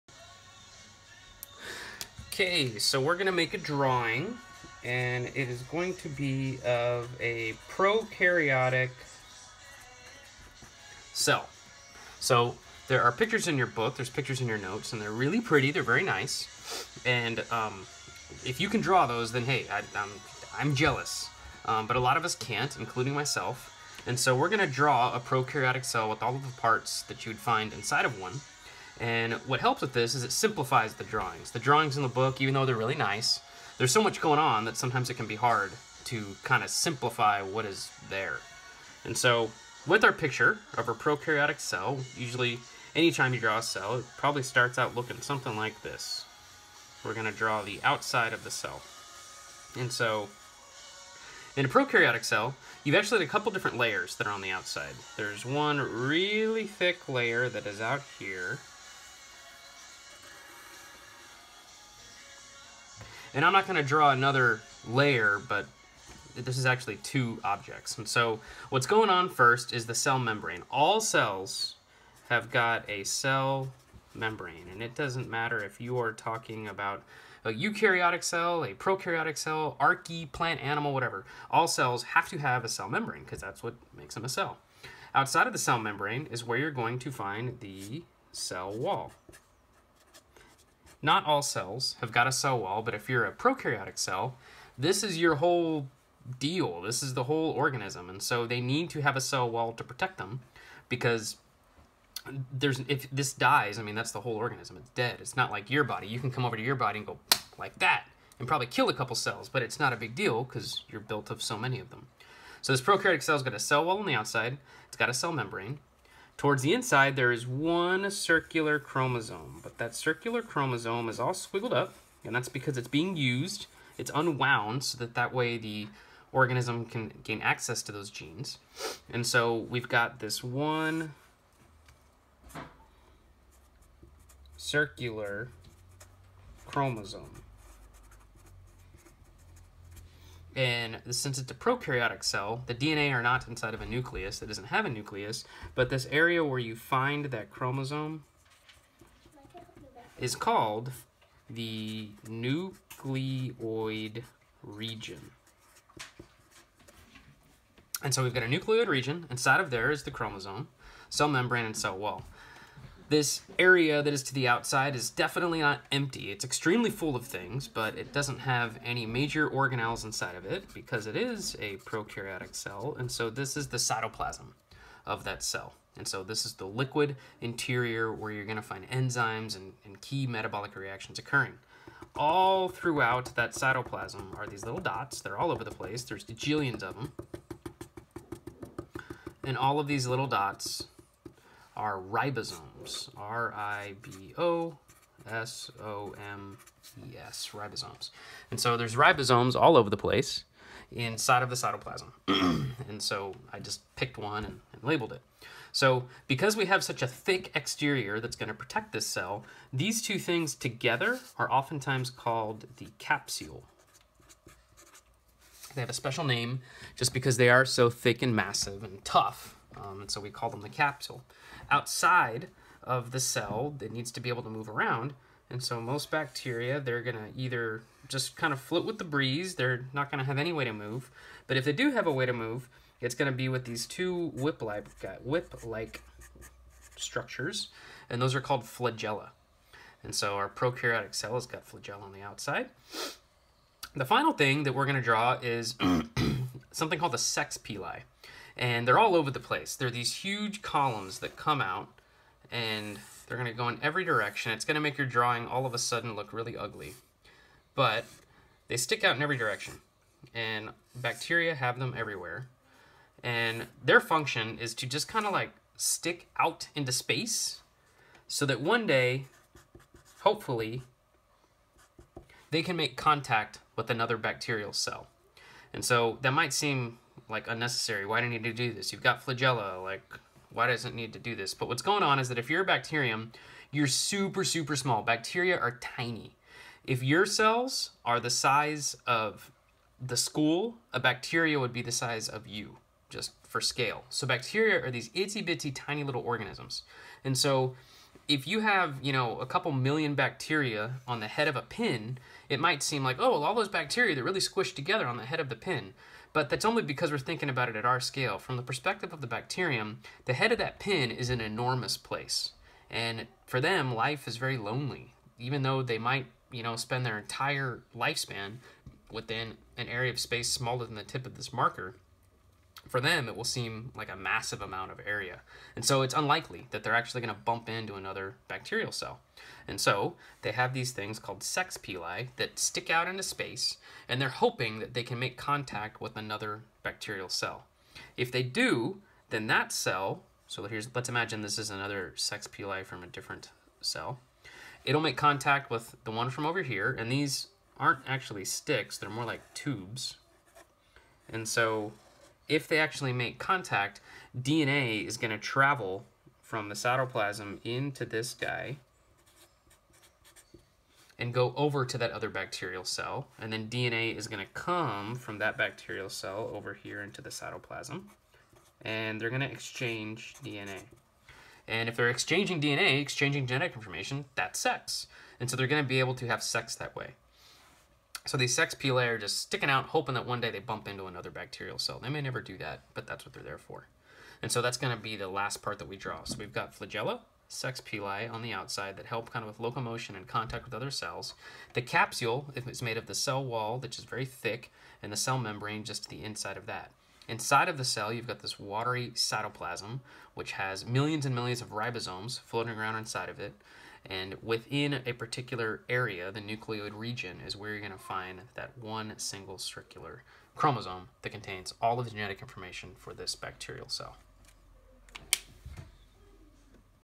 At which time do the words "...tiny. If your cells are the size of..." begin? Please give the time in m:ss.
4:45.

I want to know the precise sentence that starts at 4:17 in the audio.
But they stick out in every direction.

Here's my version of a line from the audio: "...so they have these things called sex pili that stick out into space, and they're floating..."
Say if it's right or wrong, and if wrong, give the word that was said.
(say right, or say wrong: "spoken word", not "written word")
wrong: "hoping", not "floating".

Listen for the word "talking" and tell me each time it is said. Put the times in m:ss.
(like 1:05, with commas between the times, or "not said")
1:16.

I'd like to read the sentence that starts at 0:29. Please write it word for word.
And what helps with this is it simplifies the drawings.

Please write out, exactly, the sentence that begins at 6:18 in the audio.
So these sex pili are just sticking out, hoping that one day they bump into another bacterial cell.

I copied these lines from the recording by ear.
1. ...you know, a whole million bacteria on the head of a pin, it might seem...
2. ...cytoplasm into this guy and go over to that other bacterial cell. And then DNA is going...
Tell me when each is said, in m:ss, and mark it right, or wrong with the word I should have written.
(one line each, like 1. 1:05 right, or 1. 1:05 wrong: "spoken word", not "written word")
1. 4:59 wrong: "couple", not "whole"
2. 5:56 right.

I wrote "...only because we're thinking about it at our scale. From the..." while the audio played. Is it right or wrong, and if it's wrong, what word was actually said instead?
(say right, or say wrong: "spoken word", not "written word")
right.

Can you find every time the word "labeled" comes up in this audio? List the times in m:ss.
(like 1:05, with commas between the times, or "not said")
3:24.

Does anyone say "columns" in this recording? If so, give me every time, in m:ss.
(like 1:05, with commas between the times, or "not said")
4:10.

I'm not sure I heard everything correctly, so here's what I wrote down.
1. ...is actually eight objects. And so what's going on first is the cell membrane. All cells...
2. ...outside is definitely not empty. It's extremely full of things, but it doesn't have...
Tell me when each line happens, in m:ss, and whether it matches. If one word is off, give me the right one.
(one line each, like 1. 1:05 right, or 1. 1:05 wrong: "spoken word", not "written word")
1. 1:06 wrong: "two", not "eight"
2. 2:44 right.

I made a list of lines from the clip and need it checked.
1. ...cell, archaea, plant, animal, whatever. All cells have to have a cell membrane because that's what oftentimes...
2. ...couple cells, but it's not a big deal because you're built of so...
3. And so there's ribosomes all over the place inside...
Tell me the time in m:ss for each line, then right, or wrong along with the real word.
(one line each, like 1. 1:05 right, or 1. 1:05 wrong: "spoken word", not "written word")
1. 1:19 wrong: "makes", not "oftentimes"
2. 1:48 right
3. 3:18 right.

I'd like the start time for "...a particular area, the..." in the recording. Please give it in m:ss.
6:45.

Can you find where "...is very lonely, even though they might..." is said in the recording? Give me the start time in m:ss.
5:14.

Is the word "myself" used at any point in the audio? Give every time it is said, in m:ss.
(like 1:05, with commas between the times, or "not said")
0:23.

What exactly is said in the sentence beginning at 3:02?
All throughout that cytoplasm are these little dots.